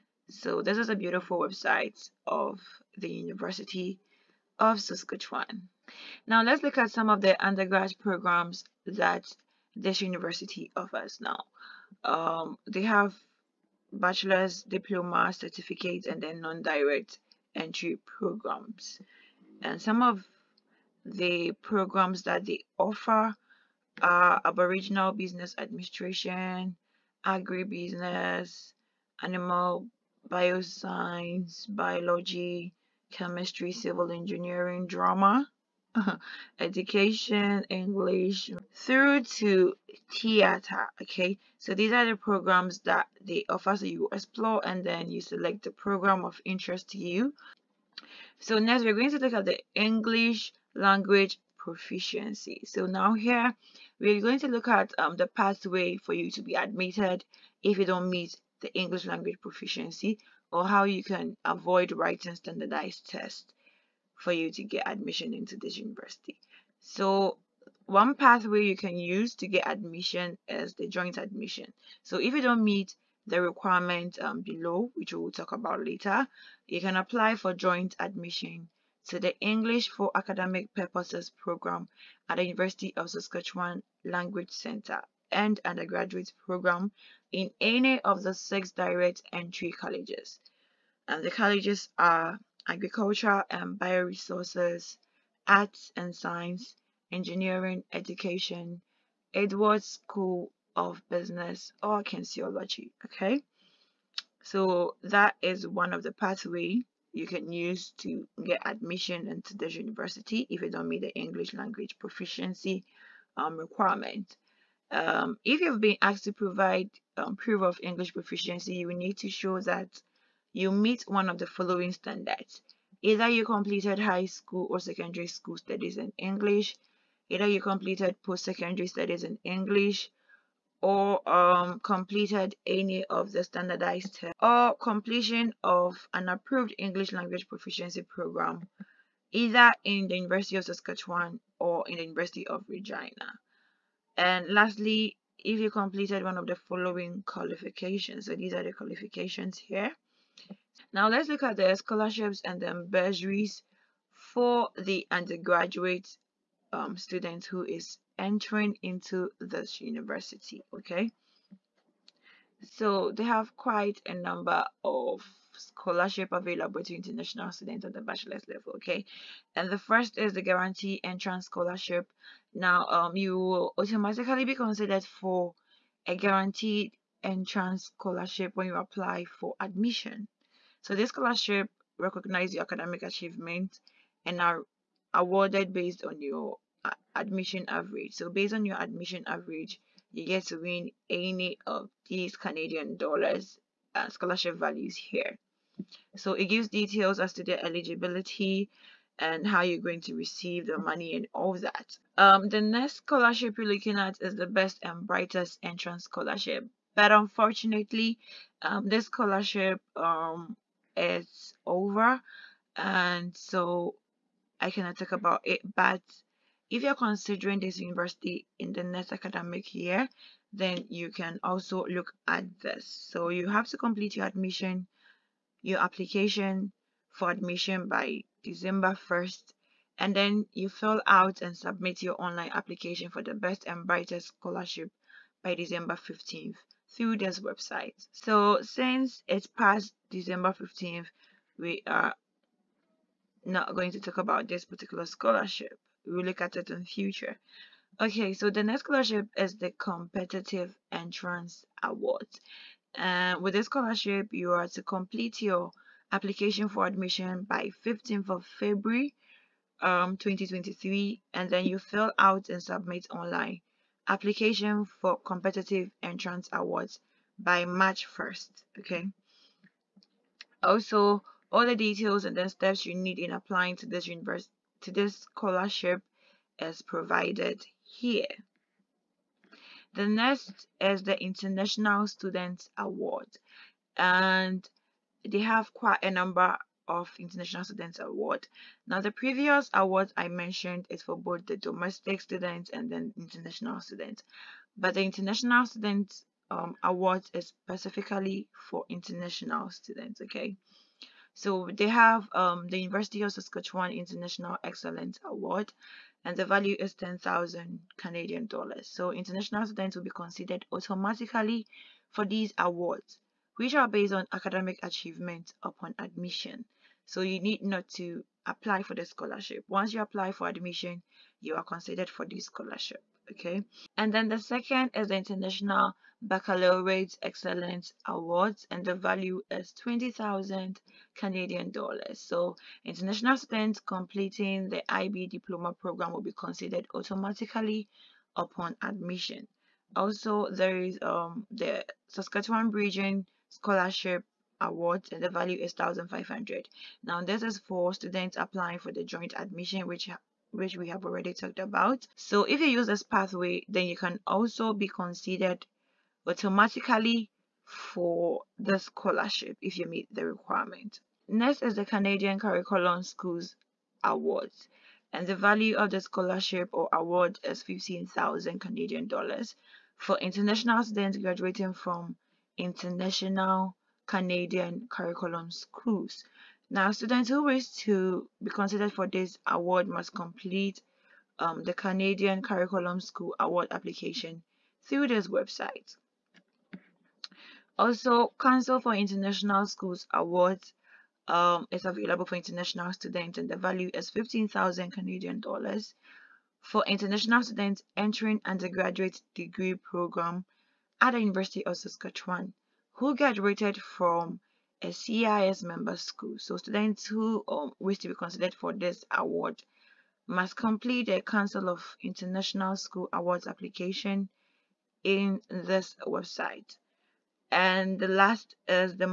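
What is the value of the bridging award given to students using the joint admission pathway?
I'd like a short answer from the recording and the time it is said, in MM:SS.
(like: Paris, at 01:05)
1,500, at 05:45.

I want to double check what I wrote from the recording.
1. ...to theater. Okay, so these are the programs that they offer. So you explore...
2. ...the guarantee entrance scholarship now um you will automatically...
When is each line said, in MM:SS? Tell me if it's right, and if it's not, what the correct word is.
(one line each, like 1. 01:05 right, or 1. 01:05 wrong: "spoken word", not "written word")
1. 00:39 right
2. 02:50 right.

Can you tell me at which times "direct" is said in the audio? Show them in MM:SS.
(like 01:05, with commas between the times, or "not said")
00:16, 01:28.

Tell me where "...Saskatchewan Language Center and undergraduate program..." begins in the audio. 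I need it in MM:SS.
01:23.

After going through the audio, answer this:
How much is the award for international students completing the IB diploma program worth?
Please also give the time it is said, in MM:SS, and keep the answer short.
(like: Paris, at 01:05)
20,000 Canadian dollars, at 05:29.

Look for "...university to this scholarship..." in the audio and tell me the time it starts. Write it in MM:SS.
04:34.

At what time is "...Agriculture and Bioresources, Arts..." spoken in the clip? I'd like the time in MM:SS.
01:32.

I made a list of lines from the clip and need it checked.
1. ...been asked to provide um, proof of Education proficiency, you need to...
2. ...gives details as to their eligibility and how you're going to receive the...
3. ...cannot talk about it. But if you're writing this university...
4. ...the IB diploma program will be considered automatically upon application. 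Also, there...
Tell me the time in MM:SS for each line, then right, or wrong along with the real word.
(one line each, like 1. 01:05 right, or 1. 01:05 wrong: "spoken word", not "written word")
1. 01:55 wrong: "English", not "Education"
2. 03:16 right
3. 03:34 wrong: "considering", not "writing"
4. 05:34 wrong: "admission", not "application".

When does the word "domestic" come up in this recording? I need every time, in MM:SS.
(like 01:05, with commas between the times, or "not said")
04:51.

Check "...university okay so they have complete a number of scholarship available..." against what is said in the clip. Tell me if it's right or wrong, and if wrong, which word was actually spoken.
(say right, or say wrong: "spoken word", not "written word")
wrong: "quite", not "complete".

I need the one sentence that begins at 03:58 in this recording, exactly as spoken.
So since it's past December 15th, we are not going to talk about this particular scholarship.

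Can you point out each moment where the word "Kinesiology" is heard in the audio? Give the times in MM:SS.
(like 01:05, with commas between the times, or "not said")
01:42.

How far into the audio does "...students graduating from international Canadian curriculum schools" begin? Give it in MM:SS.
06:10.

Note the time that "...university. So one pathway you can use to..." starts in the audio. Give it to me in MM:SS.
01:05.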